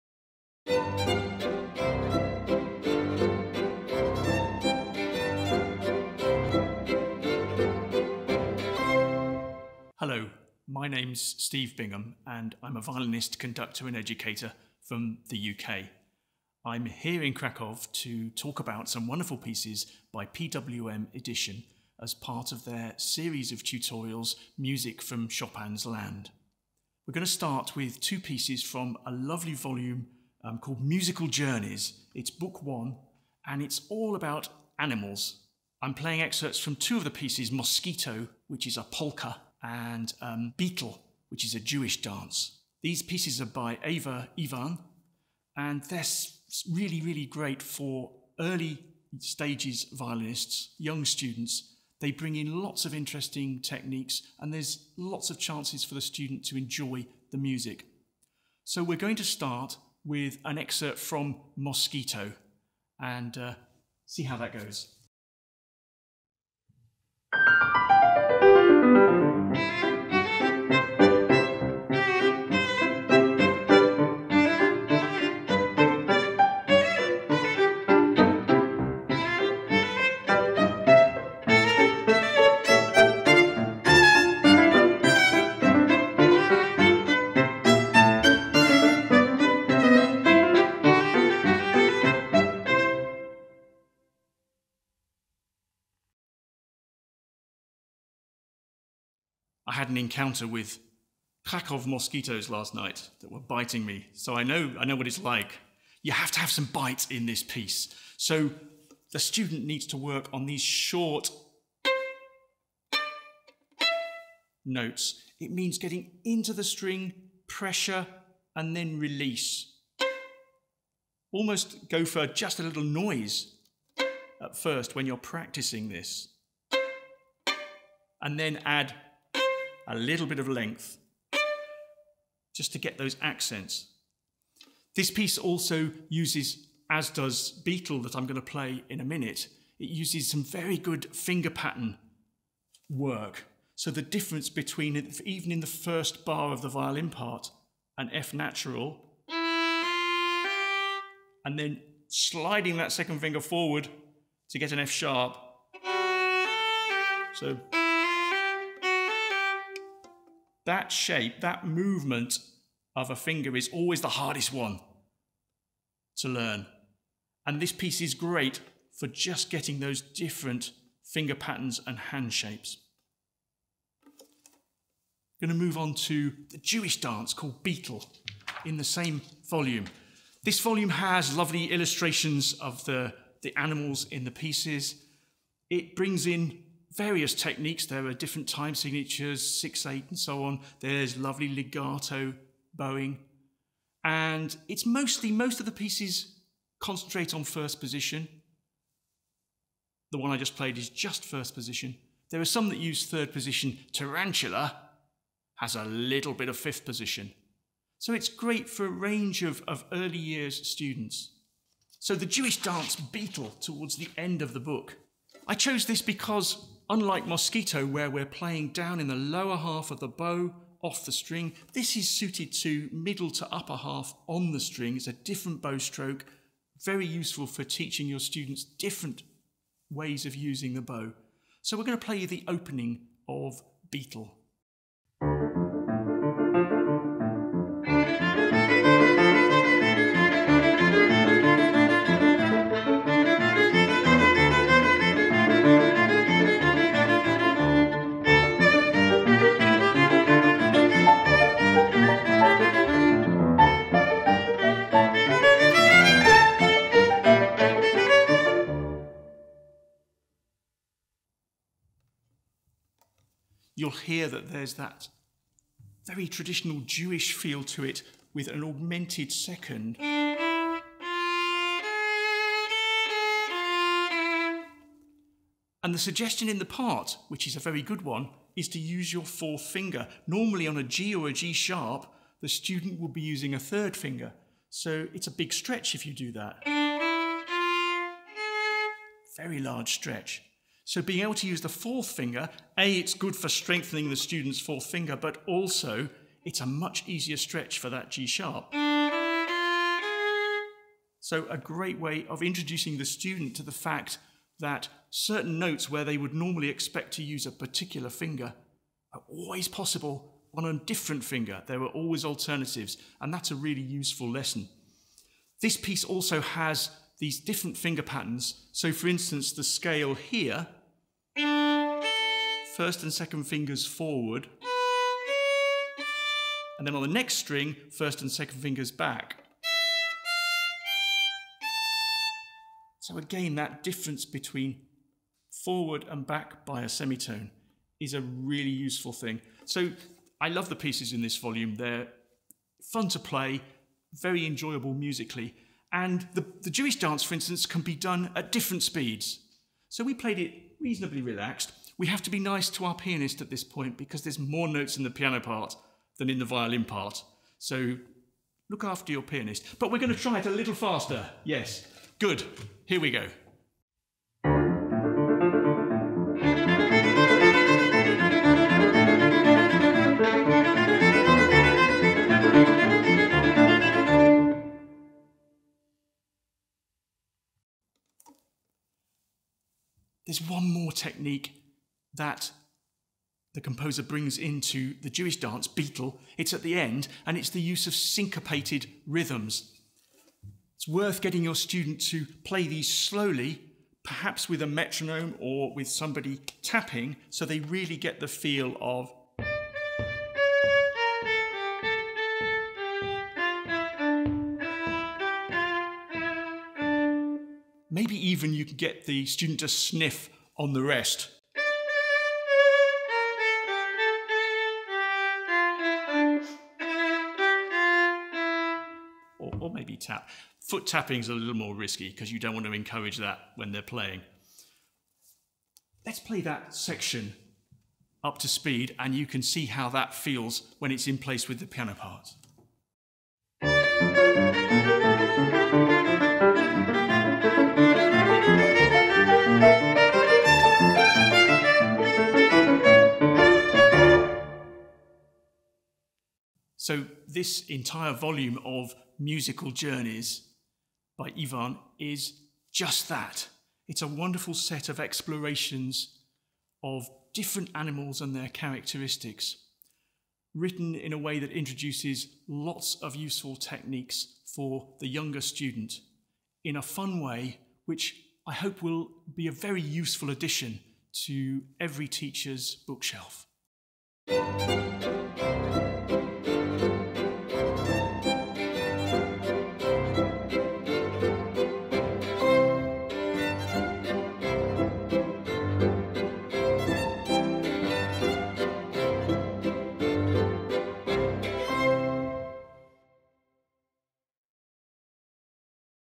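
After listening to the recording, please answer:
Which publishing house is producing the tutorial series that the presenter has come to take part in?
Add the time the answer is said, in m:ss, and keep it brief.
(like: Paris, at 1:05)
PWM Edition, at 0:20.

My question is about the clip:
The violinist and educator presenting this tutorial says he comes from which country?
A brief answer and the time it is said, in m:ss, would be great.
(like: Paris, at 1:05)
UK, at 0:15.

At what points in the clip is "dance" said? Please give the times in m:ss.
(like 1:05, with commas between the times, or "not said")
0:42, 2:57, 3:32, 5:46, 6:25.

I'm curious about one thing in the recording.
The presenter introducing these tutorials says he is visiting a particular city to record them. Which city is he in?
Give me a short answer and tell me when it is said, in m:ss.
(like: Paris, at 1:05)
Krakow, at 0:17.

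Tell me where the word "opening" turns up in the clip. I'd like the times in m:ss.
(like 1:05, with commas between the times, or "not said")
3:52.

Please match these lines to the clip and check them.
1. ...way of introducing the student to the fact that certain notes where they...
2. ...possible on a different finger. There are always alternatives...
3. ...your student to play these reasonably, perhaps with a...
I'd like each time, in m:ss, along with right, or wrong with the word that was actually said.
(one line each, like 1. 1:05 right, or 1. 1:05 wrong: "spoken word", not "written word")
1. 5:01 right
2. 5:09 right
3. 6:31 wrong: "slowly", not "reasonably".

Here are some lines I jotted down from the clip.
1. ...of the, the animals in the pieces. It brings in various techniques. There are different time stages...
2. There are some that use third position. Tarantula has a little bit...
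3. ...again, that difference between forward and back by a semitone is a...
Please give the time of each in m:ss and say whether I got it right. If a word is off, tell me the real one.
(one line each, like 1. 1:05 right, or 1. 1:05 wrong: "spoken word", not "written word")
1. 3:02 wrong: "signatures", not "stages"
2. 3:22 right
3. 5:33 right.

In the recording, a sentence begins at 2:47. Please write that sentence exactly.
And this piece is great for just getting those different finger patterns and hand shapes.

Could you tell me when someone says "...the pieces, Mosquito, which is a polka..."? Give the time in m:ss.
0:37.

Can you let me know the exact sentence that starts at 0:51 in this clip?
They bring in lots of interesting techniques, and there's lots of chances for the student to enjoy the music.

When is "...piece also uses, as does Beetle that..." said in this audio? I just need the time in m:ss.
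2:15.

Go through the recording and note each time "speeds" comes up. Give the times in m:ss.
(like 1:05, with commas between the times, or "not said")
5:48, 7:08.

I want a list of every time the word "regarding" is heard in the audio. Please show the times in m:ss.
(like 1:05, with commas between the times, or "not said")
not said.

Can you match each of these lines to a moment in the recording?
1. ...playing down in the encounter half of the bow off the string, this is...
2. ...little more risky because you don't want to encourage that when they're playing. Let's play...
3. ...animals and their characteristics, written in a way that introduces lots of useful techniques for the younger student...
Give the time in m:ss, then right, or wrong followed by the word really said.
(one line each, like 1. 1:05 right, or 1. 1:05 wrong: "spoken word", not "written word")
1. 3:38 wrong: "lower", not "encounter"
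2. 7:01 right
3. 7:37 right.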